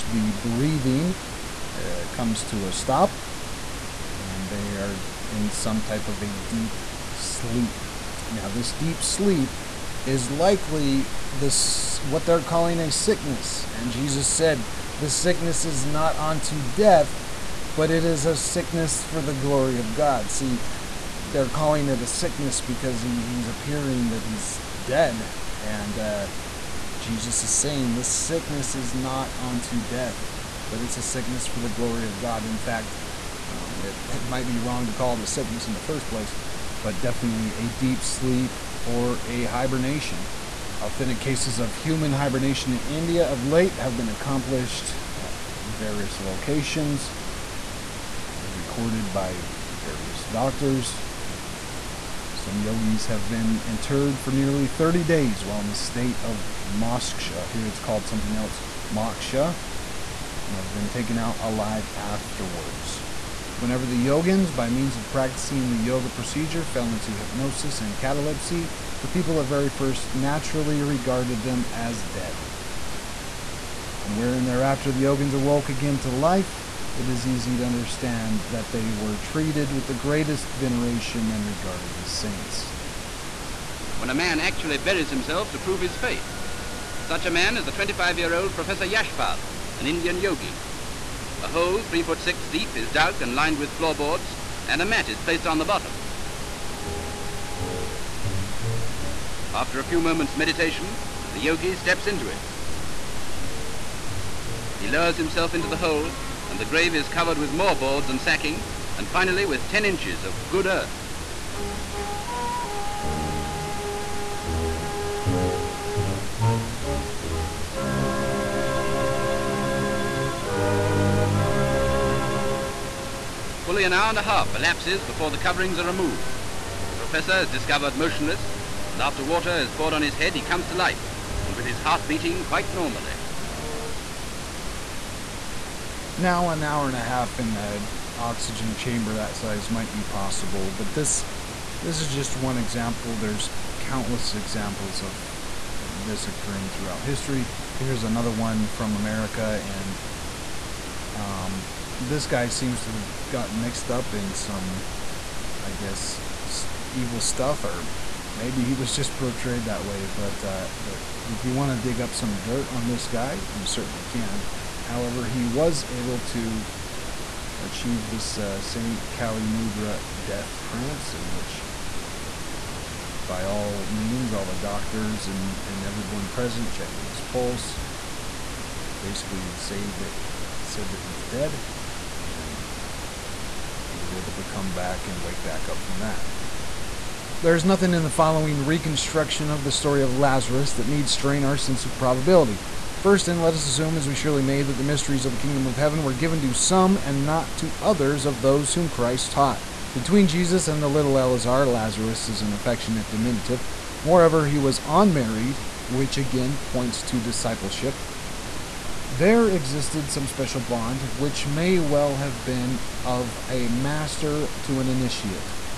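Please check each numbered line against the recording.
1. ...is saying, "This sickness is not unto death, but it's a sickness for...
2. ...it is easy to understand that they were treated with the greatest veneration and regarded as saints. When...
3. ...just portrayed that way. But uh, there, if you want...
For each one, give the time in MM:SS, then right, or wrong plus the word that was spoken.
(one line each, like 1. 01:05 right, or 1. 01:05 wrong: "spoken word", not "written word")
1. 00:27 right
2. 01:16 right
3. 02:38 right.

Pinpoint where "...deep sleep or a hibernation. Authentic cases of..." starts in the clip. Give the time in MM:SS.
00:37.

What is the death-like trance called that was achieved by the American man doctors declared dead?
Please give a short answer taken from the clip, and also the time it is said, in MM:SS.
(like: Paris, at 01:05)
Kali Mudra, at 02:49.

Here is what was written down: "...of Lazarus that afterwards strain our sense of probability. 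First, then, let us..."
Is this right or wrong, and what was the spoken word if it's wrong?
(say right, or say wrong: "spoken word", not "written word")
wrong: "needs", not "afterwards".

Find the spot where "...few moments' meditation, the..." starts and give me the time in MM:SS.
01:39.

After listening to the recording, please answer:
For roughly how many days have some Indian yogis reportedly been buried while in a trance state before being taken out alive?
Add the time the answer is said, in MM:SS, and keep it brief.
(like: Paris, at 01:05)
30, at 00:54.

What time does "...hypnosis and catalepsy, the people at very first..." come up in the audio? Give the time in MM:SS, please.
01:07.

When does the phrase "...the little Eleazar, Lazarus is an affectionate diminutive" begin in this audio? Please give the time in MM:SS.
03:20.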